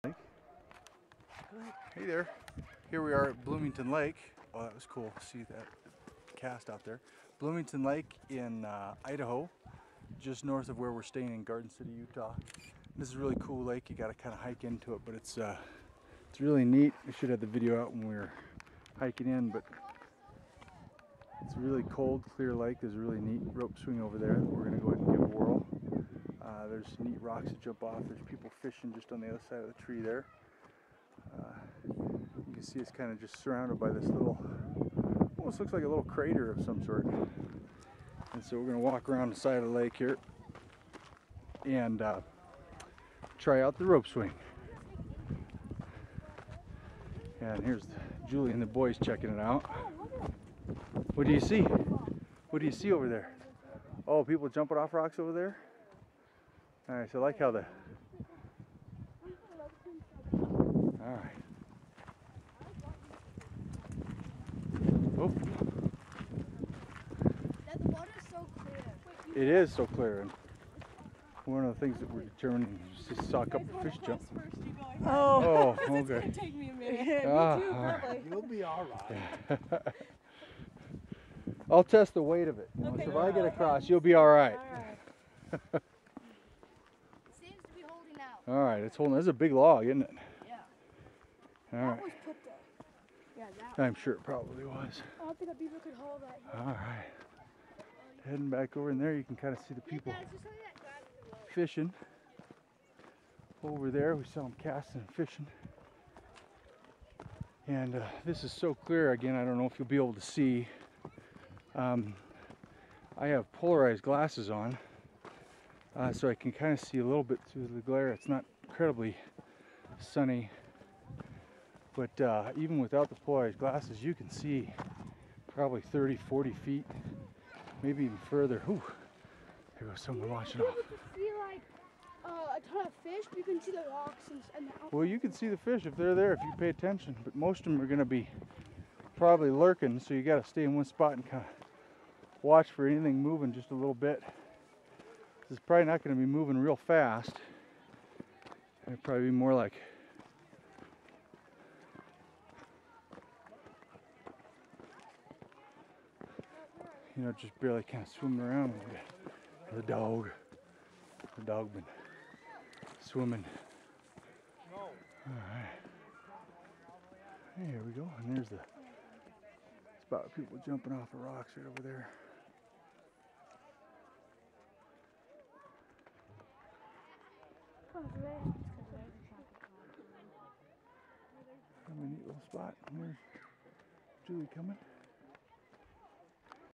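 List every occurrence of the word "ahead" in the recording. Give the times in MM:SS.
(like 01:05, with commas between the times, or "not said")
00:24.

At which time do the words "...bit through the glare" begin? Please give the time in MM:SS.
01:57.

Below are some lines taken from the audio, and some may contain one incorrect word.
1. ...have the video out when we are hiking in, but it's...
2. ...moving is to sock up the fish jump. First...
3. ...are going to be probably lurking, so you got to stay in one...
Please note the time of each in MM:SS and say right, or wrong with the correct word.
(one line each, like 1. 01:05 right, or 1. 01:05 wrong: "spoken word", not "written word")
1. 00:17 right
2. 01:12 wrong: "determining", not "moving"
3. 02:17 right.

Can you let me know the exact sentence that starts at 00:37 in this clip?
And so we're going to walk around the side of the lake here and uh, try out the rope swing.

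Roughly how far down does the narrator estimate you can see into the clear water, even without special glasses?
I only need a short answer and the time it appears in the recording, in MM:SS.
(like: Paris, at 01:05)
30 to 40 feet, at 02:05.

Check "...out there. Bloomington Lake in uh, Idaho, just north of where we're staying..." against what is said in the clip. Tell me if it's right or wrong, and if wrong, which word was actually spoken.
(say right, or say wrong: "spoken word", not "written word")
right.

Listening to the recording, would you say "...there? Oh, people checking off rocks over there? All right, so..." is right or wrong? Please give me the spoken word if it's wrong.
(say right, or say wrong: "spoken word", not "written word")
wrong: "jumping", not "checking".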